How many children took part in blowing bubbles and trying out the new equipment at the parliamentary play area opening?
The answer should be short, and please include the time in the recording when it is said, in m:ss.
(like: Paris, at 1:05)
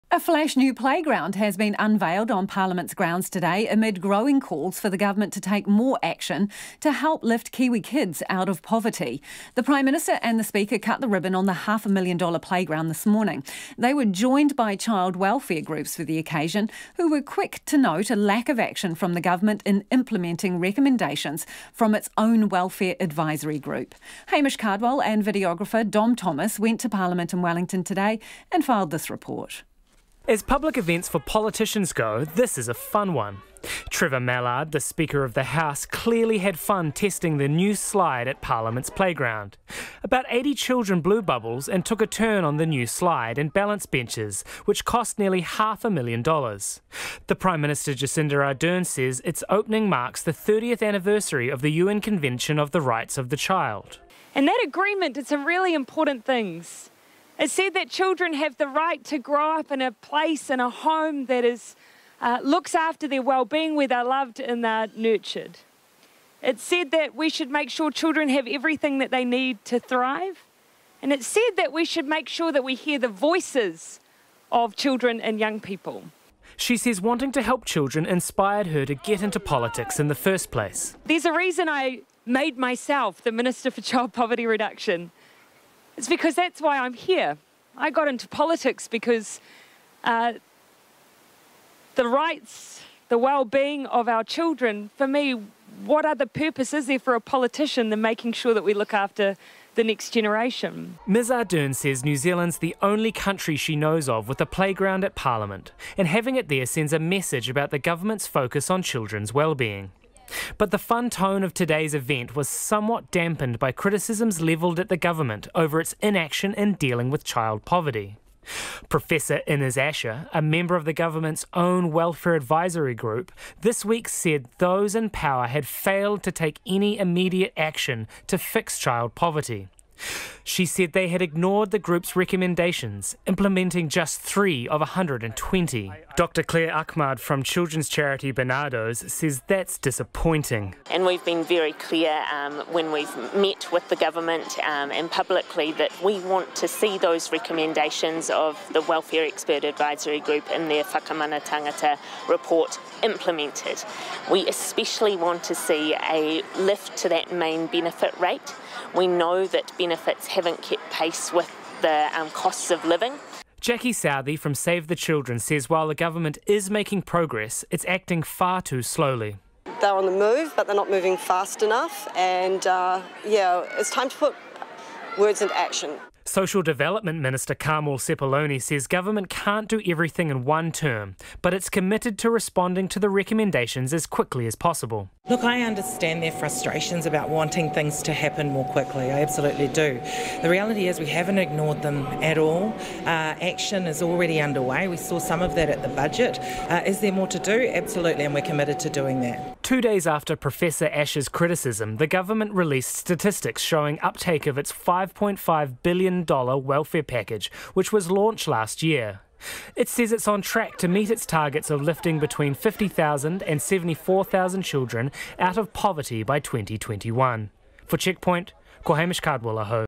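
80, at 0:40.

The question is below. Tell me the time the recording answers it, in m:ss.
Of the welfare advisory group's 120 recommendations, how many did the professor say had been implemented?
2:14.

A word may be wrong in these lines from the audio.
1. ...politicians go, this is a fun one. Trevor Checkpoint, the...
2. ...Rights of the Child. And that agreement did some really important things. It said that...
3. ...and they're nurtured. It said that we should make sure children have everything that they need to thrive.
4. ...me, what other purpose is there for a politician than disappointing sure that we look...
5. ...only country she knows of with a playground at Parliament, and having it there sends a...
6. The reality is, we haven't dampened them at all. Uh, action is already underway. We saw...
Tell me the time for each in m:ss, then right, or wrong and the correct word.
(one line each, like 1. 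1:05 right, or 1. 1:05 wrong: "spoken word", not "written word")
1. 0:31 wrong: "Mallard", not "Checkpoint"
2. 0:52 right
3. 1:04 right
4. 1:35 wrong: "making", not "disappointing"
5. 1:42 right
6. 3:10 wrong: "ignored", not "dampened".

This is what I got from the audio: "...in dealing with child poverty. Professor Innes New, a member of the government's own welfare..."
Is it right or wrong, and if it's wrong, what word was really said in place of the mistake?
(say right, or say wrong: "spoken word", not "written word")
wrong: "Asher", not "New".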